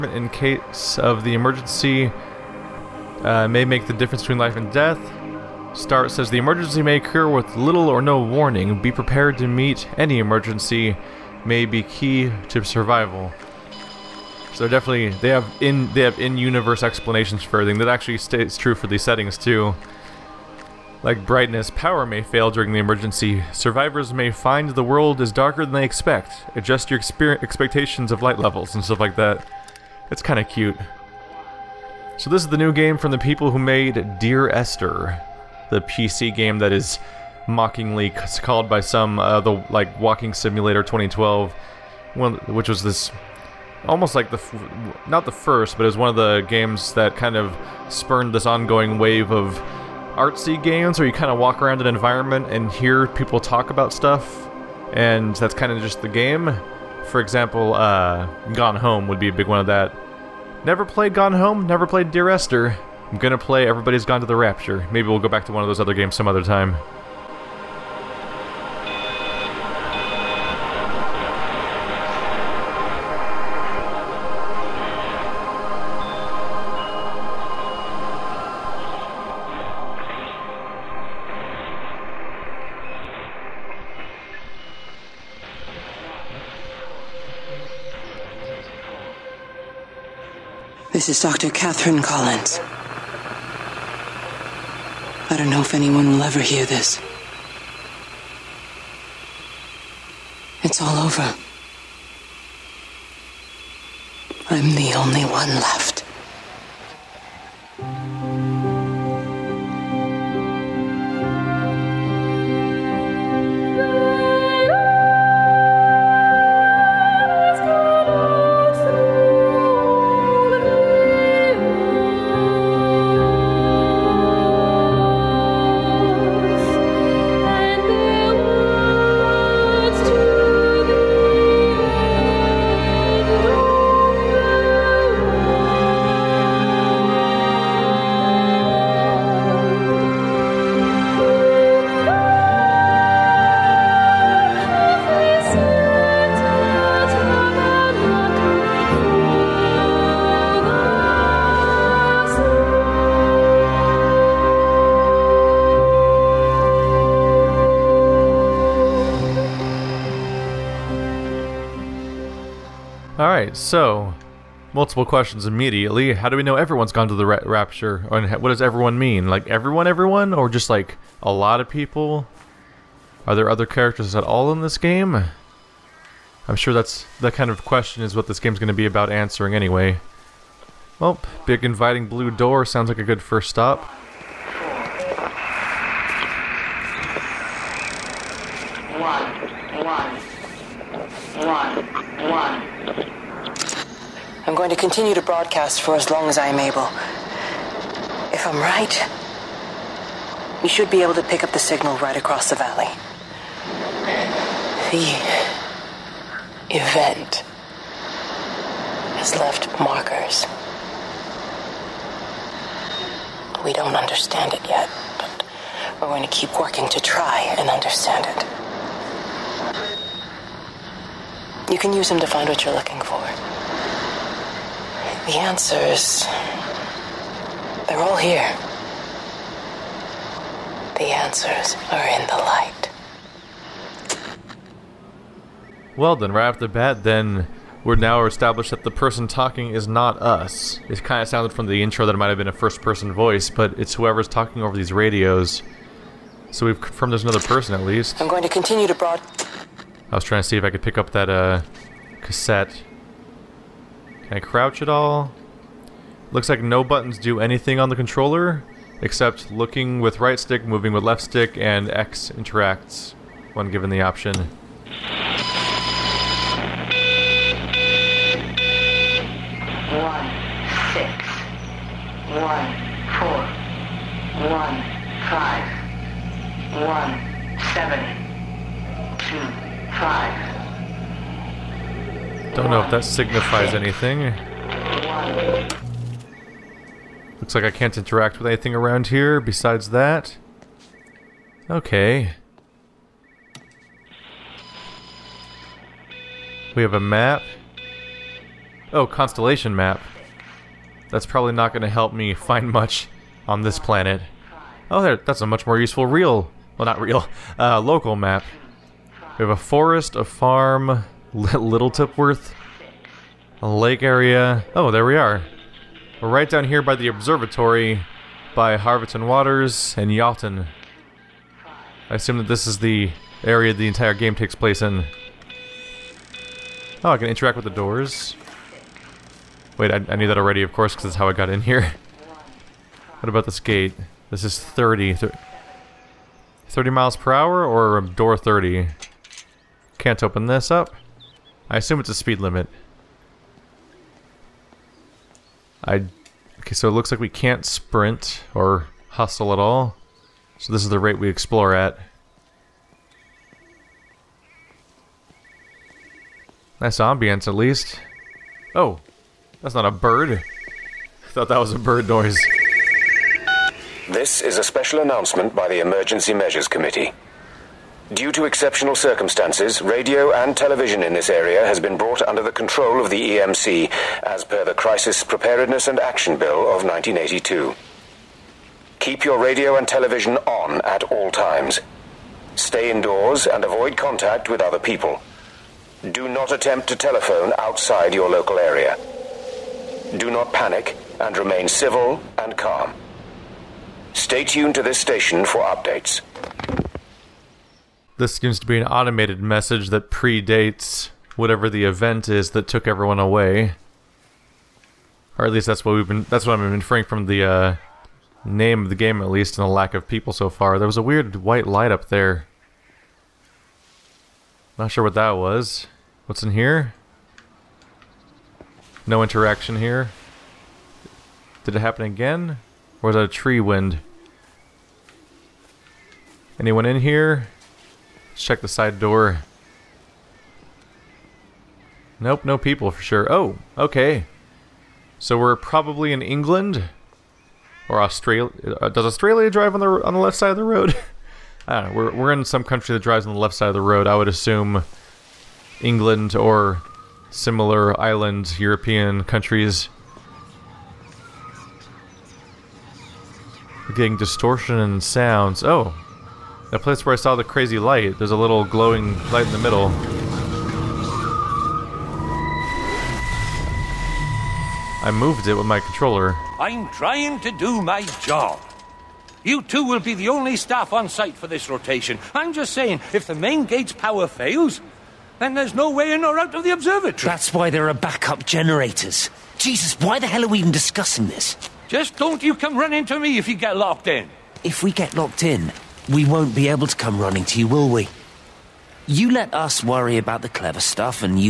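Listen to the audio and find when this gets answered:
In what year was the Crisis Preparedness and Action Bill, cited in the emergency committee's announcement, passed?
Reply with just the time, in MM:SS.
06:16.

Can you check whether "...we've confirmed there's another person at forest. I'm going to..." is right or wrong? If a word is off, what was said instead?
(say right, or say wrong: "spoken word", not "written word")
wrong: "least", not "forest".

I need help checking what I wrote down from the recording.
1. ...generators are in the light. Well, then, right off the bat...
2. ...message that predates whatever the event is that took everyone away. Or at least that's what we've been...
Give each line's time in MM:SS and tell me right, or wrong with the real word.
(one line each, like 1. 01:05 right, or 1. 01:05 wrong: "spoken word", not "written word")
1. 03:51 wrong: "answers", not "generators"
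2. 06:39 right.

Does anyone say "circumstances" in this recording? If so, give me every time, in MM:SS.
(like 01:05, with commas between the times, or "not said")
06:08.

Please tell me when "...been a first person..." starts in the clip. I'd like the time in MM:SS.
04:02.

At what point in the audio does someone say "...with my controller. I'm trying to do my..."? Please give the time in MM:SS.
07:45.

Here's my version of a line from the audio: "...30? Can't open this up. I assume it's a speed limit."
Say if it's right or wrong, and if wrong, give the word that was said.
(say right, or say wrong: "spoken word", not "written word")
right.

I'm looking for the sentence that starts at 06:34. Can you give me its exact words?
Stay tuned to this station for updates.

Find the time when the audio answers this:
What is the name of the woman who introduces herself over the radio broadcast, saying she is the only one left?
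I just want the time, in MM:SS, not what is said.
01:31.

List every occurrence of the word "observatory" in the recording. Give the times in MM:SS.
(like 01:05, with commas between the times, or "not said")
05:17, 07:56.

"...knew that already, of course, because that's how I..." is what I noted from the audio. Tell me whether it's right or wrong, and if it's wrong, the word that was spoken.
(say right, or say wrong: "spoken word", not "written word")
right.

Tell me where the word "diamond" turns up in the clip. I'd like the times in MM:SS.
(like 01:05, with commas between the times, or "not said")
not said.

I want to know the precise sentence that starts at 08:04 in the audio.
If we get locked in, we won't be able to come running to you, will we?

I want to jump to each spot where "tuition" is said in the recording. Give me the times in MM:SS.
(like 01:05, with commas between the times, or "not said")
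not said.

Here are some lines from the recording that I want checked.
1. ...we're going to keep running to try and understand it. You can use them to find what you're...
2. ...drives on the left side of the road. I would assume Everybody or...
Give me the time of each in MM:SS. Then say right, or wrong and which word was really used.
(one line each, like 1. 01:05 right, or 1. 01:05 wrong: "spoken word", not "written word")
1. 03:36 wrong: "working", not "running"
2. 07:22 wrong: "England", not "Everybody".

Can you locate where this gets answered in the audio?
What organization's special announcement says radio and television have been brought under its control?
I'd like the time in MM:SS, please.
06:05.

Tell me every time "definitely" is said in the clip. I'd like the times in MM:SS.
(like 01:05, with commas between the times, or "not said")
00:14.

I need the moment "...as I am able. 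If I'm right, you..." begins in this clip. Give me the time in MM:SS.
03:16.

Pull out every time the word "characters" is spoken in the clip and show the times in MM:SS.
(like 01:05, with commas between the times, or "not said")
02:53.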